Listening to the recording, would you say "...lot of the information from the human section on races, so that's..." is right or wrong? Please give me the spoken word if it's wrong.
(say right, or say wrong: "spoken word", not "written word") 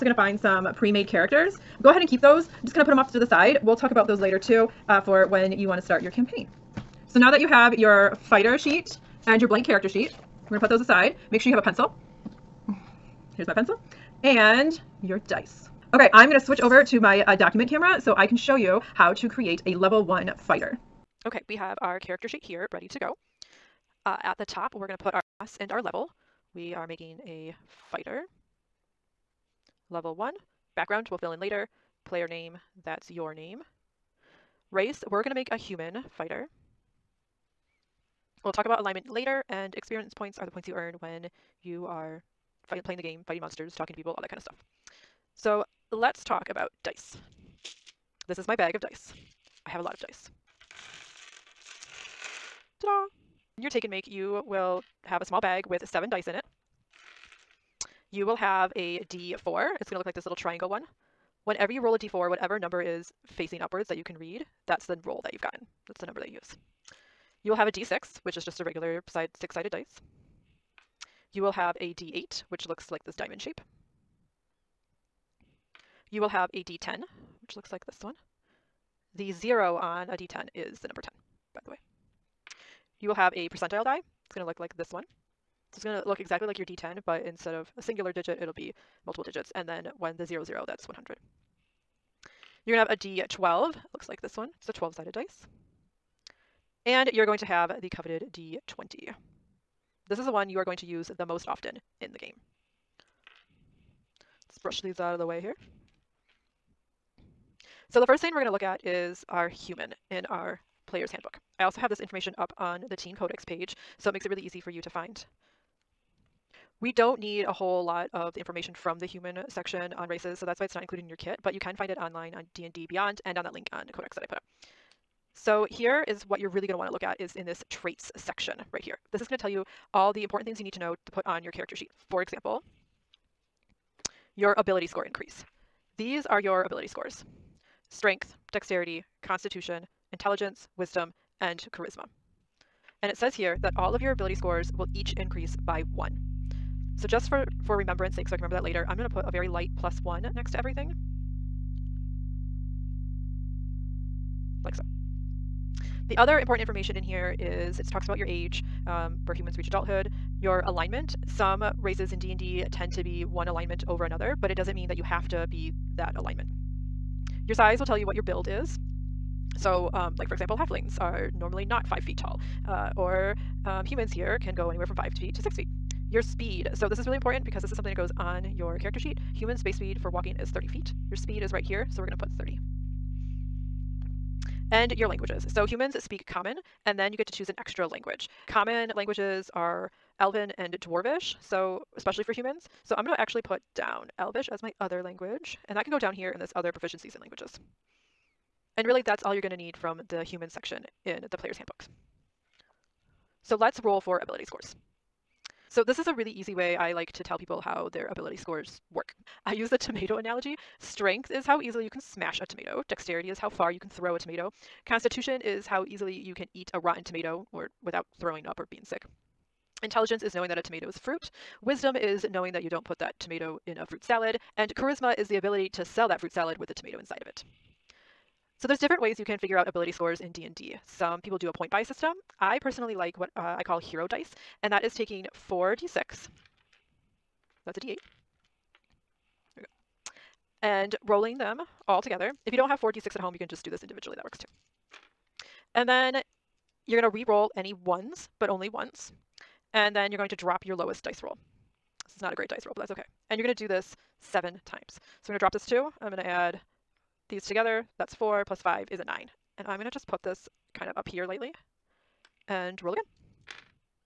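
right.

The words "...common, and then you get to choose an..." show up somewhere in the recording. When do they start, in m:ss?
3:06.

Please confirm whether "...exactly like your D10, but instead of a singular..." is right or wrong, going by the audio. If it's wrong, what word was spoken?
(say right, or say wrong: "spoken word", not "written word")
right.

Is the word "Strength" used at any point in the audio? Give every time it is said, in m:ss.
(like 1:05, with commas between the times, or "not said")
2:17, 3:30.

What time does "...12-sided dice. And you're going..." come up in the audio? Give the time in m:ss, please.
1:34.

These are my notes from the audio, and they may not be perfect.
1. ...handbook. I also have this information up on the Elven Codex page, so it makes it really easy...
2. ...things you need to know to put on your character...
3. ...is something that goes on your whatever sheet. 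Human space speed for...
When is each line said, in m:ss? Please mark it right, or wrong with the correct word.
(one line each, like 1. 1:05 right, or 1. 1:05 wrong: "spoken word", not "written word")
1. 1:51 wrong: "Teen", not "Elven"
2. 2:10 right
3. 2:57 wrong: "character", not "whatever".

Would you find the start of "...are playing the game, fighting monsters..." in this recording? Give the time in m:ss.
0:41.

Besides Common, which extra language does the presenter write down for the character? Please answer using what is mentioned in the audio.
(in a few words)
Elvish.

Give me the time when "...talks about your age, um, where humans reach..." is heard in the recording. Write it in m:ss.
2:37.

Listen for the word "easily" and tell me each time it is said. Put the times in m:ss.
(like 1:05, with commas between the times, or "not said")
3:31, 3:35.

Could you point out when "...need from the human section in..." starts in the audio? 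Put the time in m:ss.
3:19.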